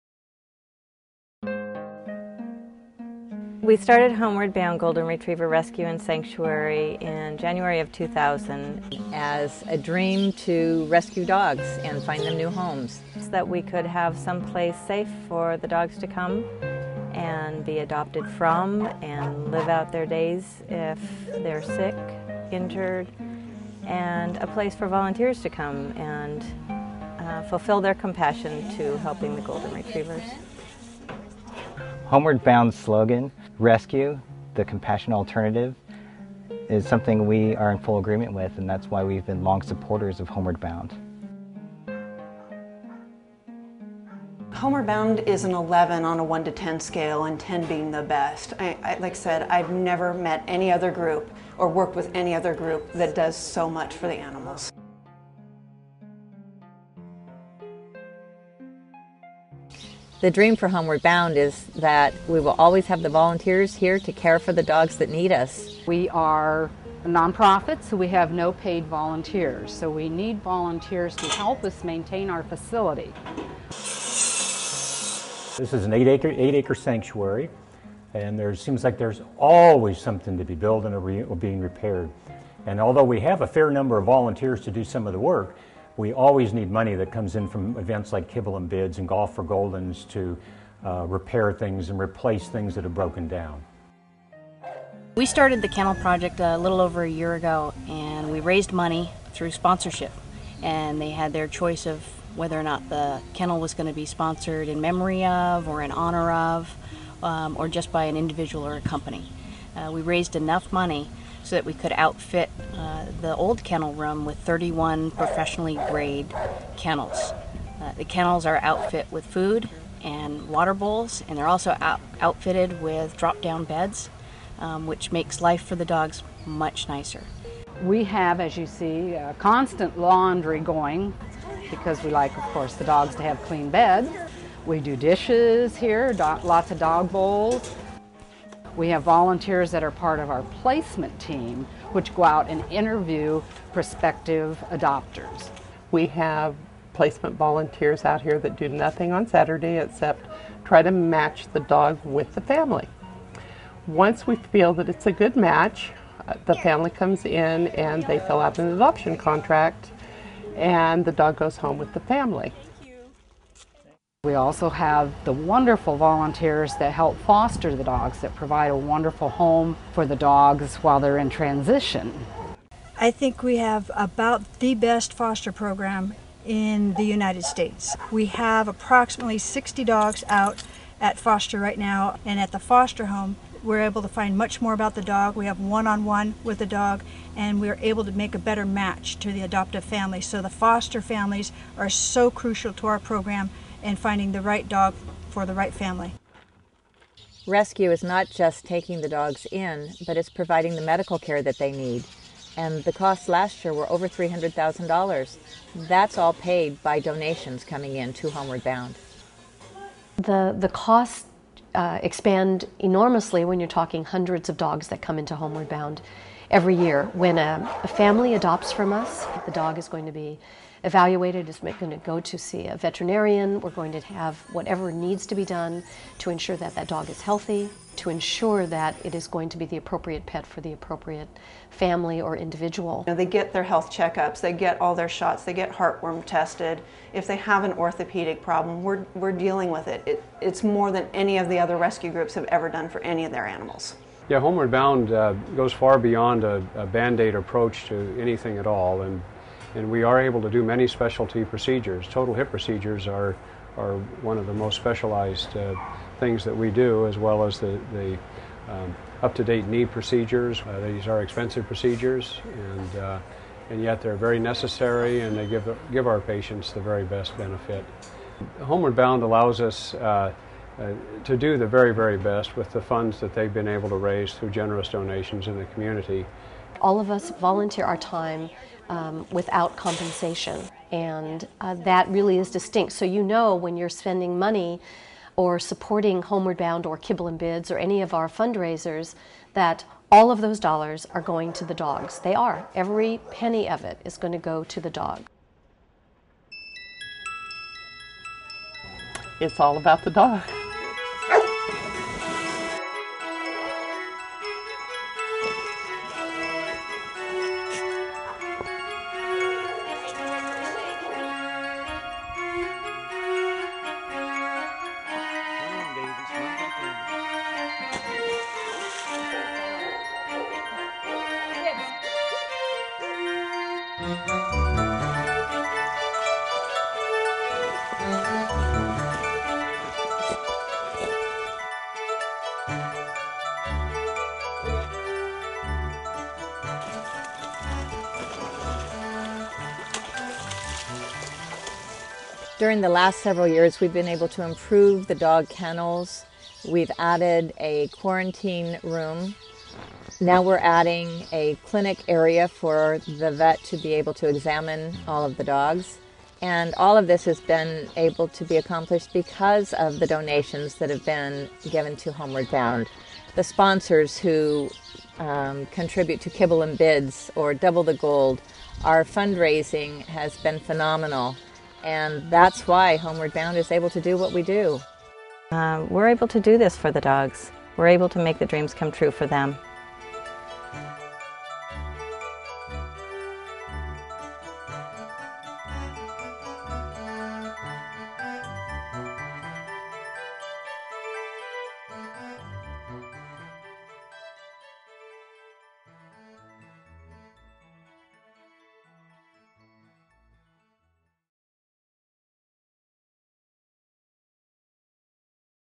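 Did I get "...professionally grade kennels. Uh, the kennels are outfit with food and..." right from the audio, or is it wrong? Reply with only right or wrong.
right.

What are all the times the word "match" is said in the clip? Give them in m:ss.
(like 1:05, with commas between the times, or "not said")
2:30, 2:35, 3:08.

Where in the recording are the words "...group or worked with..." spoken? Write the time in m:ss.
0:50.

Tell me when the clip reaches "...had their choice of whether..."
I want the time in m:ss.
1:41.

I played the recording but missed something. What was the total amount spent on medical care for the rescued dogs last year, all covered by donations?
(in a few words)
Over $300,000.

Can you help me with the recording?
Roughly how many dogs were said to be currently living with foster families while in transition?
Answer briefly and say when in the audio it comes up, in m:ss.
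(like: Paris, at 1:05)
60, at 2:59.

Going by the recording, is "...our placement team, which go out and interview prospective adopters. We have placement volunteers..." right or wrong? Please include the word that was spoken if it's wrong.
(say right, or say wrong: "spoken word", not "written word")
right.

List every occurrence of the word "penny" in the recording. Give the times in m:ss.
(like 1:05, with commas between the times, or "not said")
4:53.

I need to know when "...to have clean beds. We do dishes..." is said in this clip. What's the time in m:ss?
2:13.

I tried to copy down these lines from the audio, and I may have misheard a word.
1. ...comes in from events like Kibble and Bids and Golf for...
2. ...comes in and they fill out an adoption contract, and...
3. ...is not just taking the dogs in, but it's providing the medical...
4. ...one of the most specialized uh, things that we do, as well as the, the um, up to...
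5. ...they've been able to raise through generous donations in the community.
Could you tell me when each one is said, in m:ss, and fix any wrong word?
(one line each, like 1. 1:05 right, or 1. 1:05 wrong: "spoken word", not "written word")
1. 1:27 right
2. 2:36 right
3. 3:17 right
4. 4:14 right
5. 4:33 right.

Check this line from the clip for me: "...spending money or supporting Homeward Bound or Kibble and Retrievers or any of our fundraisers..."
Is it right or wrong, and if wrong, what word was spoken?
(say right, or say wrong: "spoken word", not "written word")
wrong: "Bids", not "Retrievers".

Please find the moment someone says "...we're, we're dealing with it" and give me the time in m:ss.
3:58.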